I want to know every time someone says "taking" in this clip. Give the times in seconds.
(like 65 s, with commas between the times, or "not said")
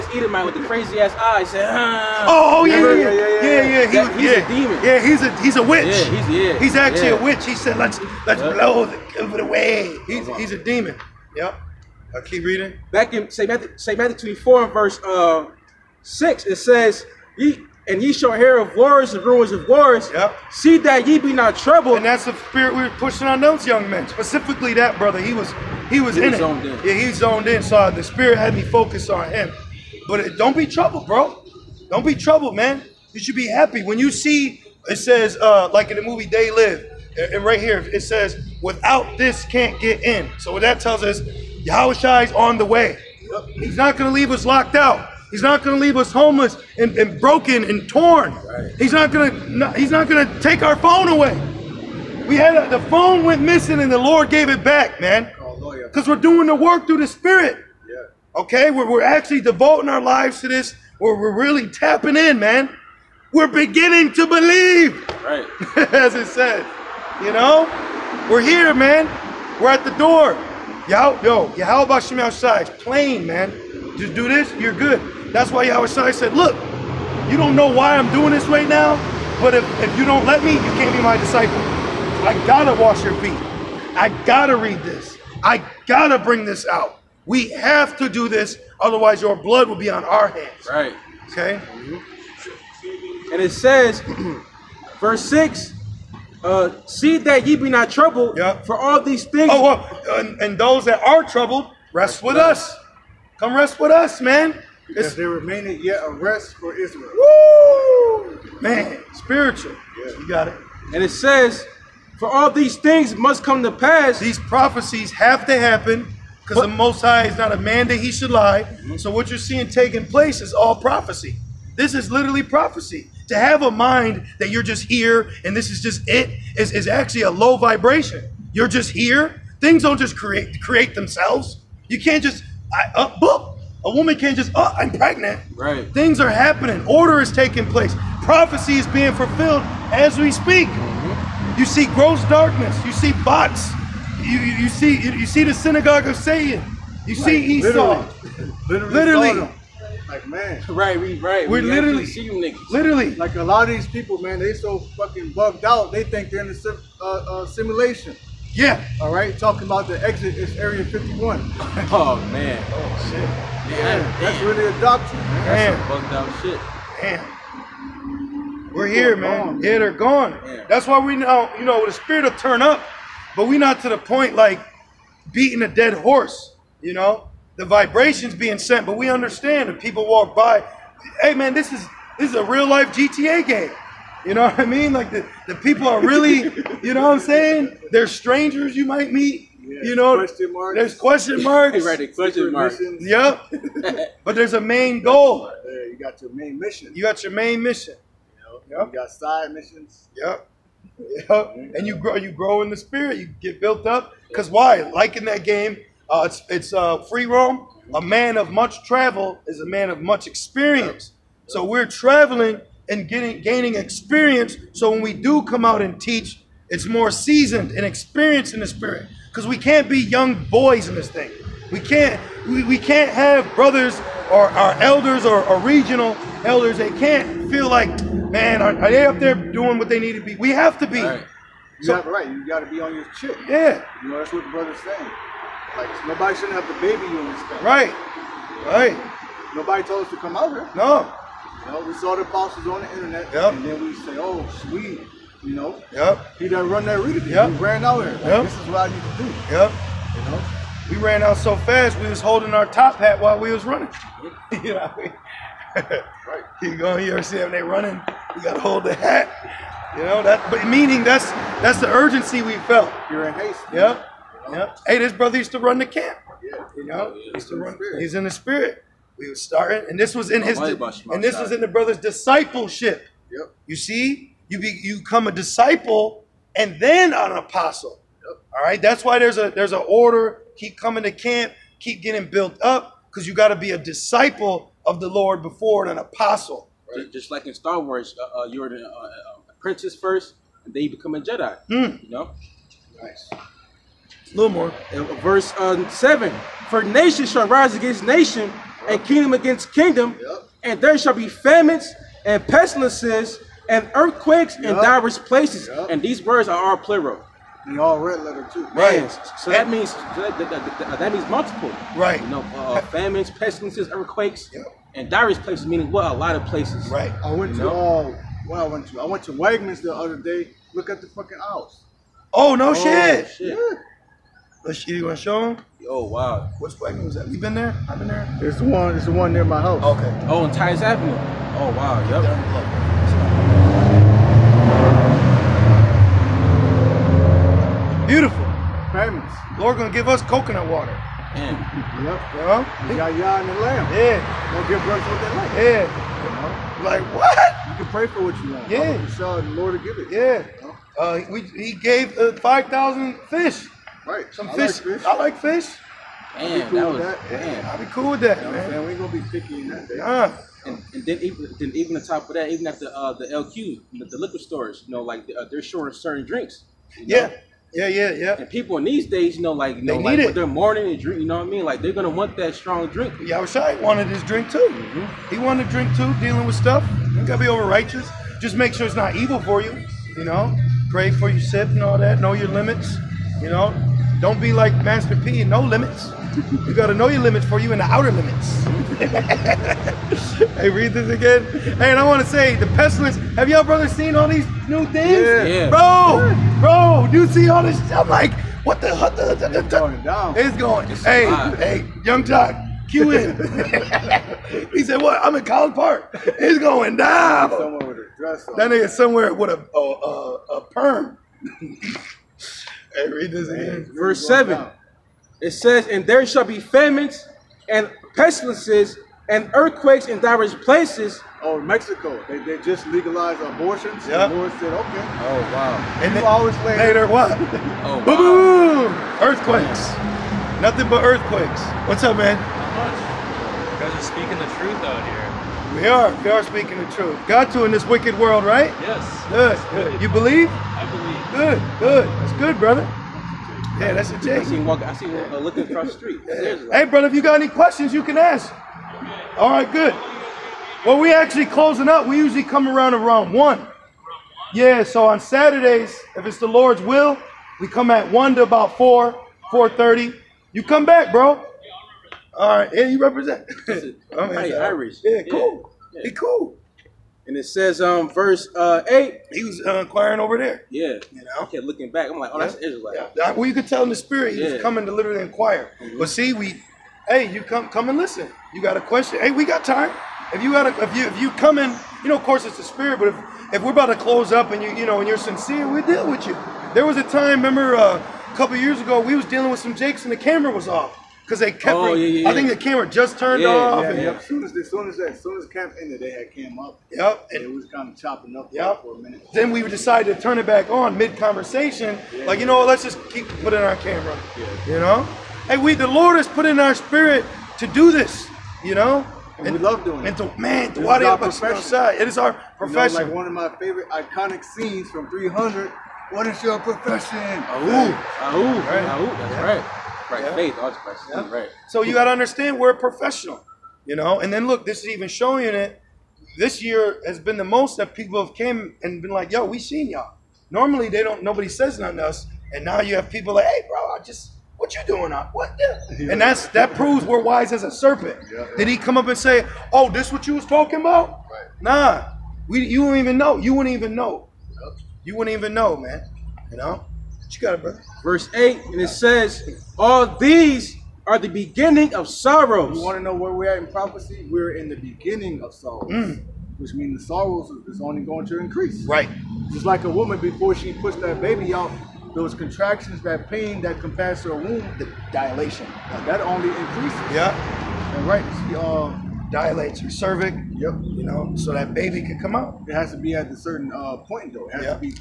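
119 s, 137 s.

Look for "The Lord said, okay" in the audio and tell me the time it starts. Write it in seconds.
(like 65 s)
424 s.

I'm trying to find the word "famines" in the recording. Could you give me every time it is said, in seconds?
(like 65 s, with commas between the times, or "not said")
301 s, 312 s, 416 s.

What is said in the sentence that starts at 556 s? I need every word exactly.
which means the sorrows is only going to increase.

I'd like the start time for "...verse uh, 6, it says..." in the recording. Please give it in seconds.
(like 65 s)
14 s.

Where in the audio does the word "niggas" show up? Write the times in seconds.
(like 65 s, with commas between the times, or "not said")
152 s, 408 s.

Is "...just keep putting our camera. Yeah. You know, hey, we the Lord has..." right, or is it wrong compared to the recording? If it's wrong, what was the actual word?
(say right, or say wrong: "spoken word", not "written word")
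right.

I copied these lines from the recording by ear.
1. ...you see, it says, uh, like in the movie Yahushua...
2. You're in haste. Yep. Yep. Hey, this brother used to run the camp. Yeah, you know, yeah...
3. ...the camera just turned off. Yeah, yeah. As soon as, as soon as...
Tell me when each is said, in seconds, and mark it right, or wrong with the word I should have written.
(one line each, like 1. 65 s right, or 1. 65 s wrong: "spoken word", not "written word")
1. 33 s wrong: "They", not "Yahushua"
2. 263 s right
3. 492 s right.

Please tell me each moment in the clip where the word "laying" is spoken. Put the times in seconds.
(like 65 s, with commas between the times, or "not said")
not said.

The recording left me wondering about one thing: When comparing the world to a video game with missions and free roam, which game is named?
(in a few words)
GTA.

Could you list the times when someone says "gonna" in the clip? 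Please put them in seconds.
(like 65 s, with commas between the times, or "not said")
324 s, 339 s, 359 s, 371 s.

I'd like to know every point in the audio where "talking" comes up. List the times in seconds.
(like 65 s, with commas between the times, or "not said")
159 s, 540 s.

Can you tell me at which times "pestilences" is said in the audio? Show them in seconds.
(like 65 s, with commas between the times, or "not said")
302 s, 313 s, 392 s, 418 s.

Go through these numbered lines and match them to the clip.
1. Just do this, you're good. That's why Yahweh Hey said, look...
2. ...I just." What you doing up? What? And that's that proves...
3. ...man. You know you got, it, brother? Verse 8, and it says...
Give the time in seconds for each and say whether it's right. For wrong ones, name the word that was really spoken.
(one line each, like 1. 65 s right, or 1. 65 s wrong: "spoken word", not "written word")
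1. 73 s wrong: "Shai", not "Hey"
2. 533 s right
3. 545 s right.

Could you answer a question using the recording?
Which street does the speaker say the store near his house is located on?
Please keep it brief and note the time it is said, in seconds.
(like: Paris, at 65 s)
Titus Avenue, at 330 s.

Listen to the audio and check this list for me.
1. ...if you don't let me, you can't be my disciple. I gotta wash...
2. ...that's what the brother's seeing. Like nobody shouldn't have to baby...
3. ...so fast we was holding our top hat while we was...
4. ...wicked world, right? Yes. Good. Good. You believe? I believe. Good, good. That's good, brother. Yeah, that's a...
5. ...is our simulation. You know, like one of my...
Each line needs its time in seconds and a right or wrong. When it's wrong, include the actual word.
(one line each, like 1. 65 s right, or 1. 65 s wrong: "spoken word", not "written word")
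1. 79 s right
2. 234 s wrong: "saying", not "seeing"
3. 251 s right
4. 437 s right
5. 512 s wrong: "profession", not "simulation".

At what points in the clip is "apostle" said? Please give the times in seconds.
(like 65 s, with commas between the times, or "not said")
242 s, 277 s, 285 s.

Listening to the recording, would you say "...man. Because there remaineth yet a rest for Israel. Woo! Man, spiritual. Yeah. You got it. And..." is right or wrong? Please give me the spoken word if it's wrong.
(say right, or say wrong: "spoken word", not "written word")
right.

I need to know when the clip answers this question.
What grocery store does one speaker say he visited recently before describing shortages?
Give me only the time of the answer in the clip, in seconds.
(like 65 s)
319 s.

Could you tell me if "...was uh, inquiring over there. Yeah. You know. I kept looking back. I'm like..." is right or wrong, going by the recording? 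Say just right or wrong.
right.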